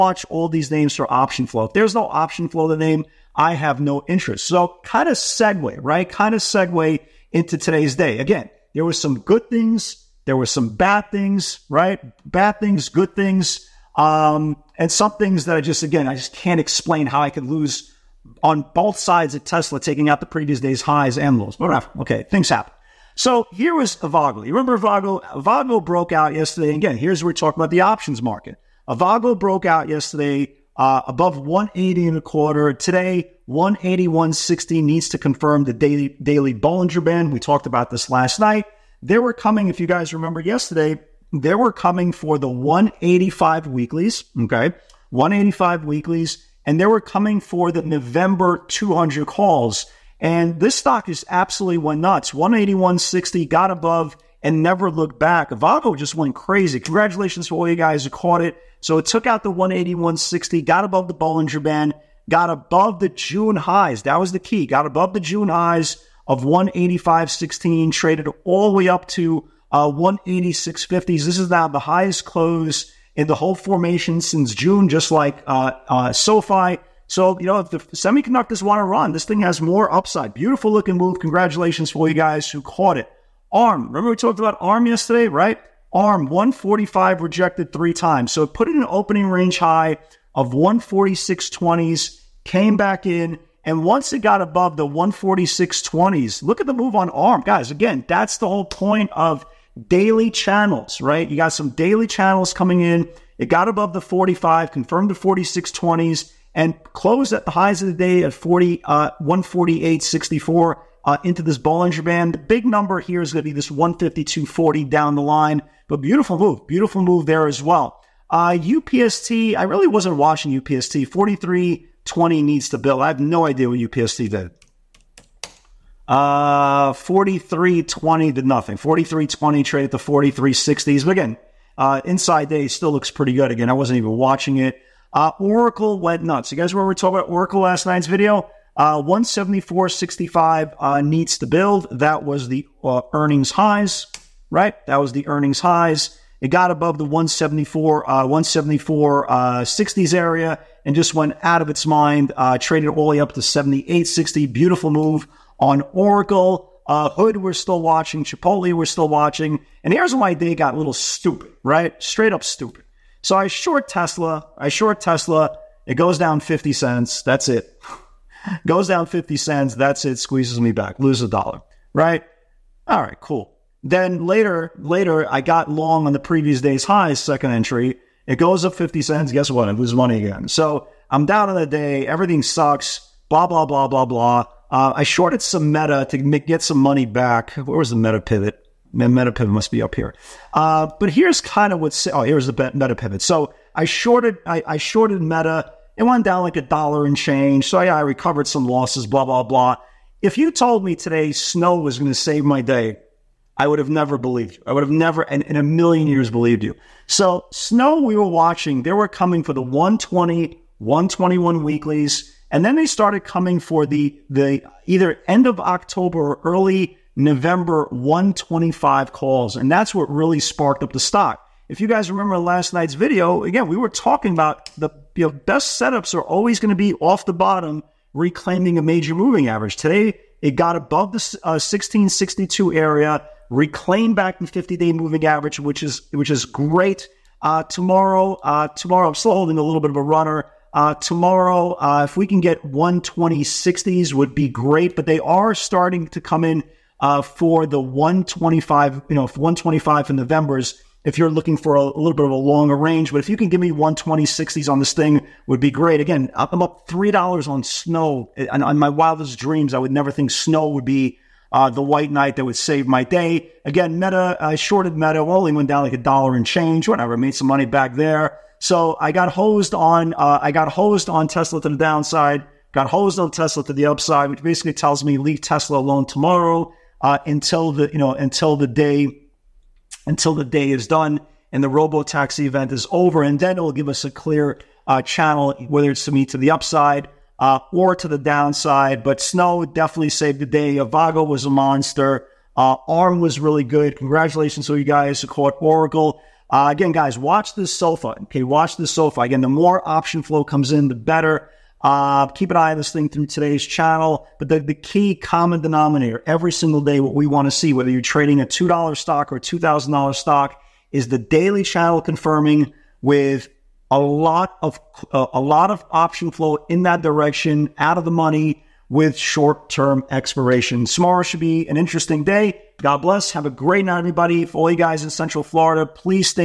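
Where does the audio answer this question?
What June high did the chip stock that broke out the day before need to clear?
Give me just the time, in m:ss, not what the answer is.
1:06.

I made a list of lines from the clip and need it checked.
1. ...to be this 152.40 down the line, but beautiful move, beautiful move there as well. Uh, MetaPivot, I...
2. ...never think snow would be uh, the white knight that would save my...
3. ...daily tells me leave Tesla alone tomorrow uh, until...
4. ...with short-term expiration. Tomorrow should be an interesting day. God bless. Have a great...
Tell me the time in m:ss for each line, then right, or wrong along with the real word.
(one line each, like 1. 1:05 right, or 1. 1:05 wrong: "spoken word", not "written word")
1. 1:53 wrong: "UPST", not "MetaPivot"
2. 4:19 right
3. 4:34 wrong: "basically", not "daily"
4. 5:18 right.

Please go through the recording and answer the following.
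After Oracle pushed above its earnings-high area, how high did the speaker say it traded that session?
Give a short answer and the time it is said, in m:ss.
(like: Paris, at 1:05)
78.60, at 2:33.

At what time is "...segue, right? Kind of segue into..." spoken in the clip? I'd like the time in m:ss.
0:05.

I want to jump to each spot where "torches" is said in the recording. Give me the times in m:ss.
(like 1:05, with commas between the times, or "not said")
not said.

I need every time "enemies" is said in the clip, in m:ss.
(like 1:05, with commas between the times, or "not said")
not said.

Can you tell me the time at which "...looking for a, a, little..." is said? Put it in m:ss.
4:11.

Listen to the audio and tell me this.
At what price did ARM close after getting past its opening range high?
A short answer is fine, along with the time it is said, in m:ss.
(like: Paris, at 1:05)
148.64, at 1:49.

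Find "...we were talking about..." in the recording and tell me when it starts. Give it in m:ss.
3:43.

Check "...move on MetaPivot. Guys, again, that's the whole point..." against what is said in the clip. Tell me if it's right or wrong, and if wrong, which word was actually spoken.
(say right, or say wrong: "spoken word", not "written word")
wrong: "ARM", not "MetaPivot".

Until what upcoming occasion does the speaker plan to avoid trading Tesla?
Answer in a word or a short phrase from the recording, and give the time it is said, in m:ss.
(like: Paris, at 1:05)
robo taxi event, at 4:41.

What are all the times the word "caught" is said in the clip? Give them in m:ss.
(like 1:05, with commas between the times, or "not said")
0:58, 1:22, 4:55.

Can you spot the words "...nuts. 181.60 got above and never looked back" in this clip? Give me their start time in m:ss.
0:51.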